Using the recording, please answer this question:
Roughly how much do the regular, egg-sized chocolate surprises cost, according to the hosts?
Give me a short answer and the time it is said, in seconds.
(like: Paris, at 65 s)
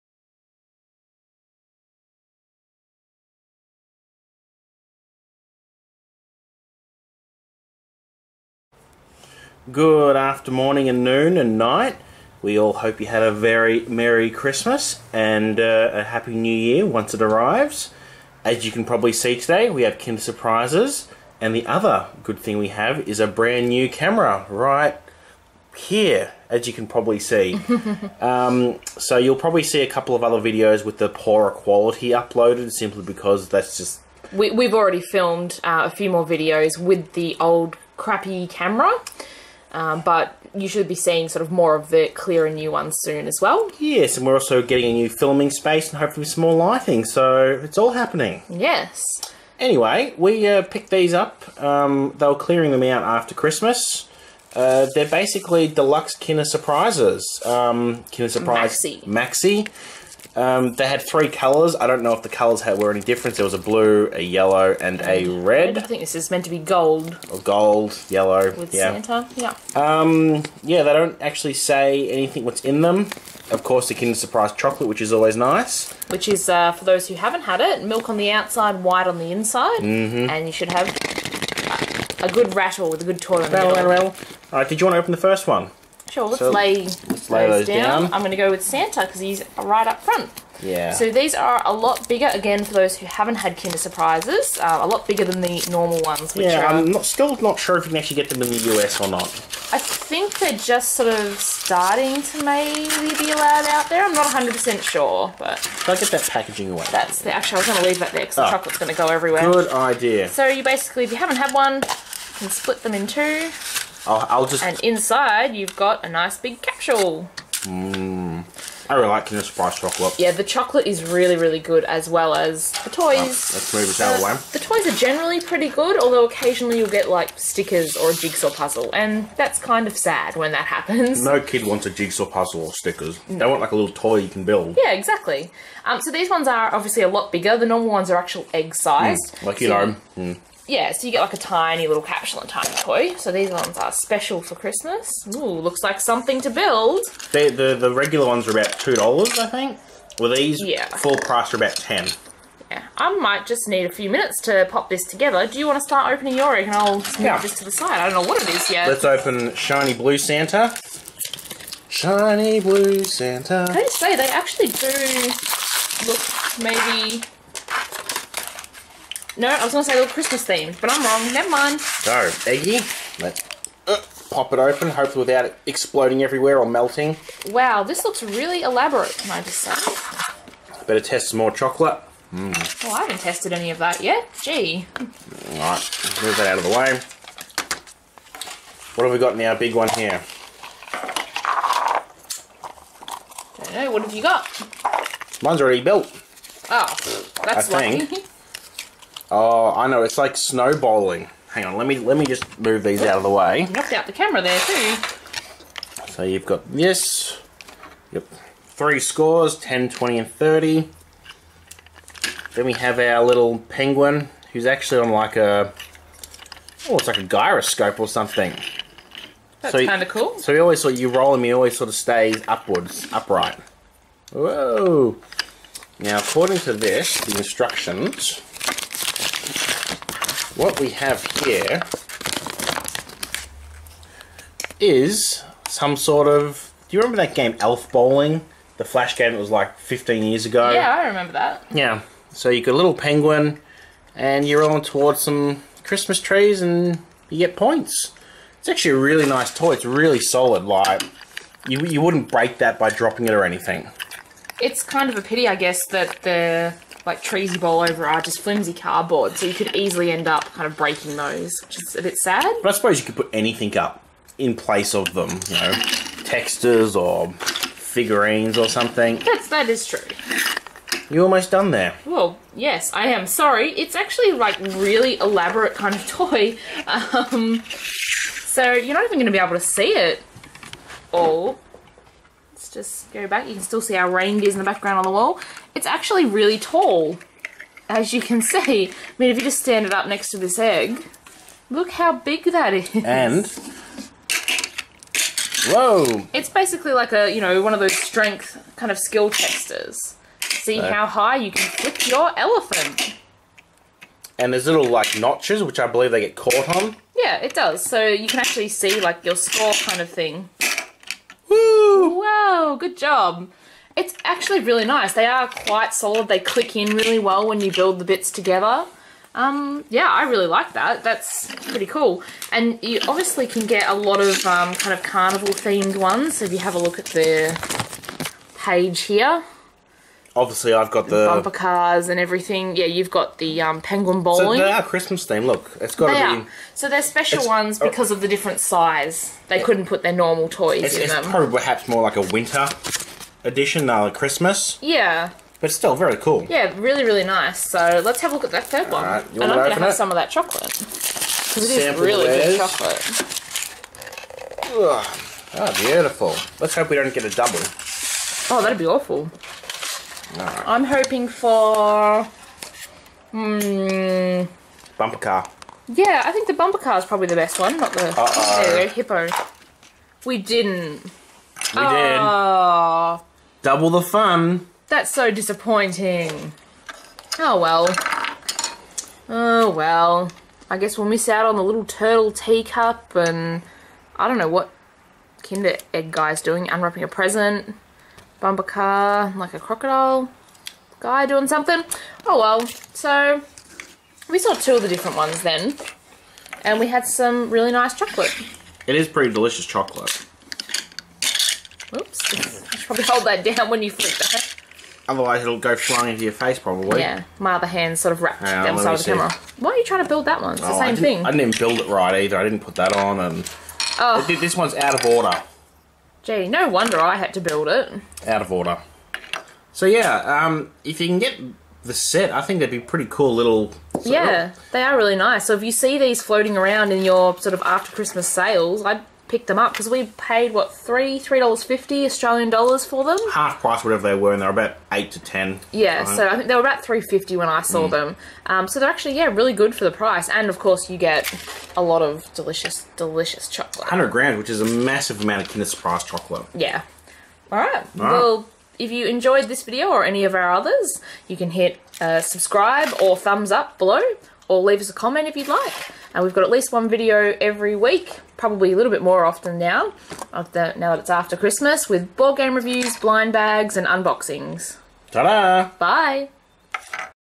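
$2, at 148 s.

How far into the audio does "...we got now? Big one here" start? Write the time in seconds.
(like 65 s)
189 s.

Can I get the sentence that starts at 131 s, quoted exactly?
No kid wants a jigsaw puzzle or stickers.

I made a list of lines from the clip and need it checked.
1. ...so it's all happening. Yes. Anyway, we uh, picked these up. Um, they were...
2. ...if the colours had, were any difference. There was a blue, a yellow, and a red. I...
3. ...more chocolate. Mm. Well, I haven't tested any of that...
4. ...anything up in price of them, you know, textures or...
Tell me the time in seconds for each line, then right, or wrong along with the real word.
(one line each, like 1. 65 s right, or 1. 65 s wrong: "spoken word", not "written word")
1. 47 s right
2. 62 s right
3. 181 s right
4. 263 s wrong: "place", not "price".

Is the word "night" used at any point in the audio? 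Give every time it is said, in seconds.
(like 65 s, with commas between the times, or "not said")
11 s.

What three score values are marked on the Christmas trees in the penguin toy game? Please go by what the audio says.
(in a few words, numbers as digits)
10, 20, and 30.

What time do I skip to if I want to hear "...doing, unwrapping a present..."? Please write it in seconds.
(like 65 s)
386 s.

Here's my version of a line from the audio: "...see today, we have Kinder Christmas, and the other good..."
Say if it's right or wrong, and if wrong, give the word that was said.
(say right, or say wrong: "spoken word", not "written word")
wrong: "Surprises", not "Christmas".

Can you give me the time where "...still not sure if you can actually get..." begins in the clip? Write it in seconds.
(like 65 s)
97 s.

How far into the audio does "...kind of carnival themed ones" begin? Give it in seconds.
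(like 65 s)
324 s.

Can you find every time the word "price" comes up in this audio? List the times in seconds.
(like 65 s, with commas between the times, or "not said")
151 s, 433 s, 439 s.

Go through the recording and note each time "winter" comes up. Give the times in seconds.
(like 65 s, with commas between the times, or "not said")
342 s.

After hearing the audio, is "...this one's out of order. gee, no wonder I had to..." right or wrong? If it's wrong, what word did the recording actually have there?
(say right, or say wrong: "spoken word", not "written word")
right.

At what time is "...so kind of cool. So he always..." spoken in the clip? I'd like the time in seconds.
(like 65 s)
219 s.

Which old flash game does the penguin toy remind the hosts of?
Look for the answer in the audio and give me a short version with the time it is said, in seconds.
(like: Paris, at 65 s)
Elf Bowling, at 237 s.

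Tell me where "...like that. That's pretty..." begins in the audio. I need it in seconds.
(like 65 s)
320 s.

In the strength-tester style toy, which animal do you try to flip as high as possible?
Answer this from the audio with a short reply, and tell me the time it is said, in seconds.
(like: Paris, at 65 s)
elephant, at 302 s.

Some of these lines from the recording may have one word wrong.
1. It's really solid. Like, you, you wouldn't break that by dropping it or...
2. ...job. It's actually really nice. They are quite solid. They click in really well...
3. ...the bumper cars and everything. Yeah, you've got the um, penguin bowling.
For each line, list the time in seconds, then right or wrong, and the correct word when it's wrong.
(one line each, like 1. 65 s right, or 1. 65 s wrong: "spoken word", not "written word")
1. 249 s right
2. 312 s right
3. 331 s right.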